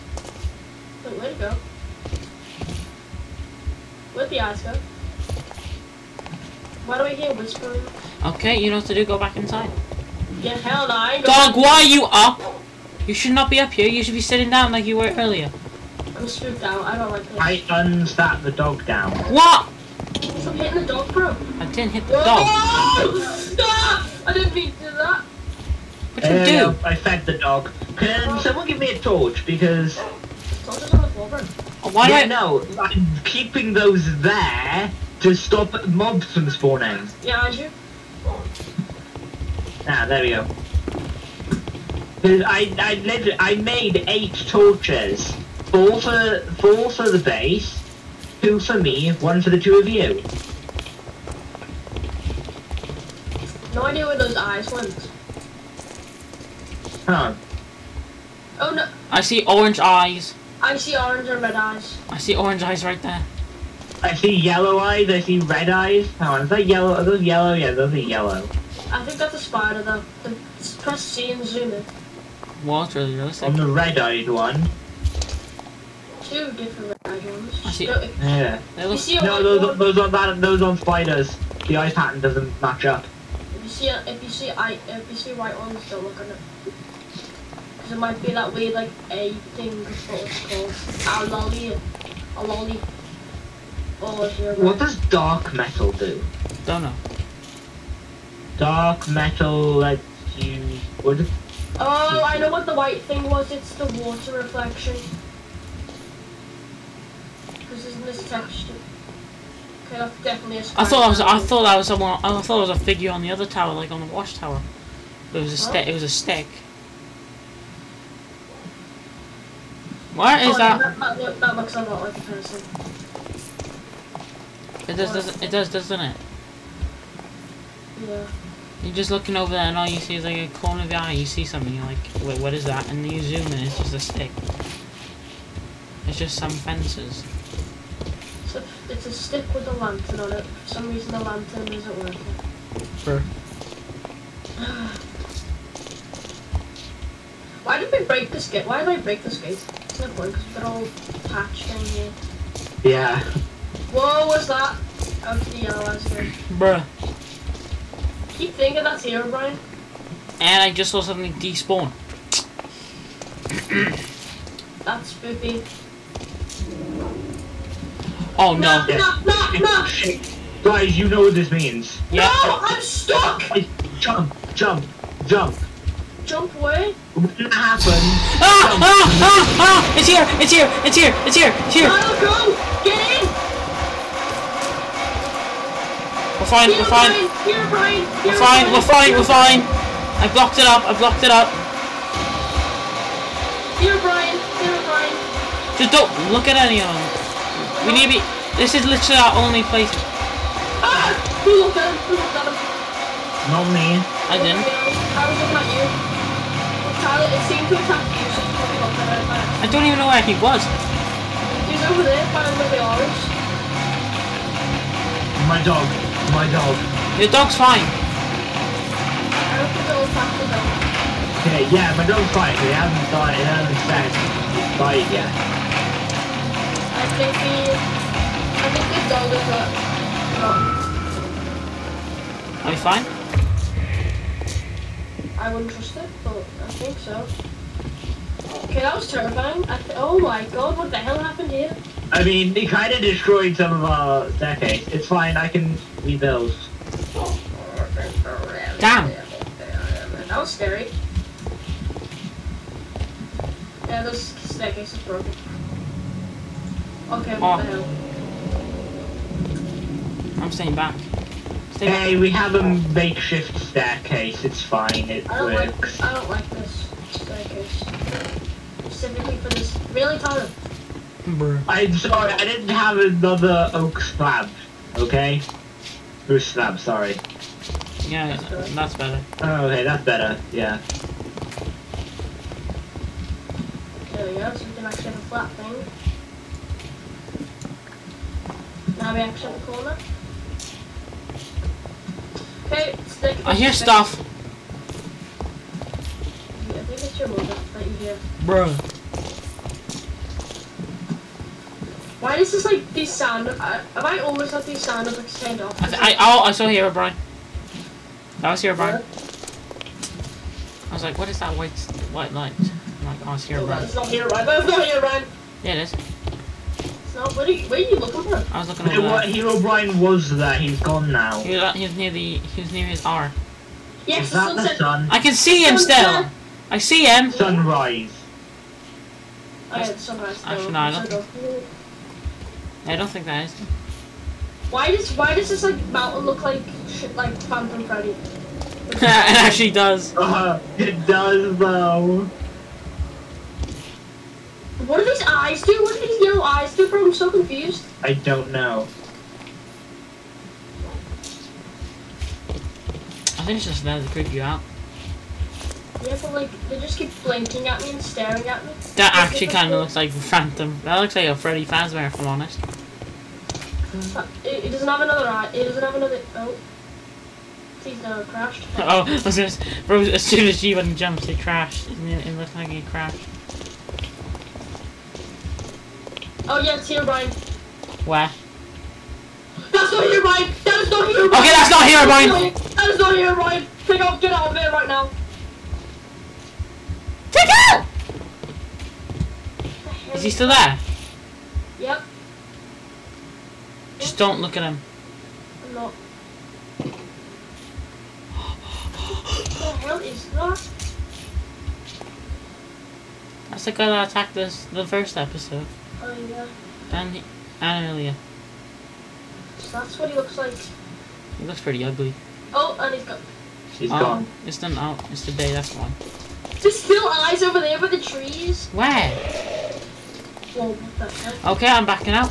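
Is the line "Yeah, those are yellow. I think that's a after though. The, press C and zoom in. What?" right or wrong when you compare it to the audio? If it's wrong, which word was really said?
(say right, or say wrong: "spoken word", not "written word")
wrong: "spider", not "after".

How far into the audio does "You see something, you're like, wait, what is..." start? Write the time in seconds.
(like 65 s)
131 s.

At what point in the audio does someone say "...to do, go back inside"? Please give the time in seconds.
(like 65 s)
8 s.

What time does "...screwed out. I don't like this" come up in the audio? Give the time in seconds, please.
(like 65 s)
16 s.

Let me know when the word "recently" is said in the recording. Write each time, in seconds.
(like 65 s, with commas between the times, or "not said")
not said.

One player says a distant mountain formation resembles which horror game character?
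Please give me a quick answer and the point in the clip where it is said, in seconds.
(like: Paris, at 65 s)
Phantom Freddy, at 337 s.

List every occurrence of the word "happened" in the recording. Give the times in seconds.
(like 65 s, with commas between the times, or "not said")
177 s, 241 s.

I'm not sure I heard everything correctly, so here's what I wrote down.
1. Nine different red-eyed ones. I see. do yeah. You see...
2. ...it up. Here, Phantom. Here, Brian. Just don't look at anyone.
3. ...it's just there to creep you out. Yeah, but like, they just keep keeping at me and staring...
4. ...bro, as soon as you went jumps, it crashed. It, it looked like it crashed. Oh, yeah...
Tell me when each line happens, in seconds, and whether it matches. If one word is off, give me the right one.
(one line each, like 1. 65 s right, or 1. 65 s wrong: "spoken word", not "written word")
1. 76 s wrong: "Two", not "Nine"
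2. 191 s wrong: "Brian", not "Phantom"
3. 353 s wrong: "blinking", not "keeping"
4. 369 s right.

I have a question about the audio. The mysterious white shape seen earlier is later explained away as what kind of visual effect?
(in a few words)
water reflection.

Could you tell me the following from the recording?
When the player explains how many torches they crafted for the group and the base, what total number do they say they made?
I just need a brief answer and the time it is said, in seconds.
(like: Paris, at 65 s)
8, at 44 s.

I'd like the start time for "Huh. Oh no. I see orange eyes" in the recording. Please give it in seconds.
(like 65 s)
57 s.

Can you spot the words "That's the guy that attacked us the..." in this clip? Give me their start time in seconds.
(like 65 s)
403 s.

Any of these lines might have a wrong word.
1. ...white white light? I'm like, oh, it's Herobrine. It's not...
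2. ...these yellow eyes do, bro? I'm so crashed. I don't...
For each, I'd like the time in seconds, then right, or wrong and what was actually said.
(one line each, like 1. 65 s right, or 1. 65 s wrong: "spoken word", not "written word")
1. 311 s right
2. 346 s wrong: "confused", not "crashed".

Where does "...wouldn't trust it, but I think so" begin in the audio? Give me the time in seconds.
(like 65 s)
235 s.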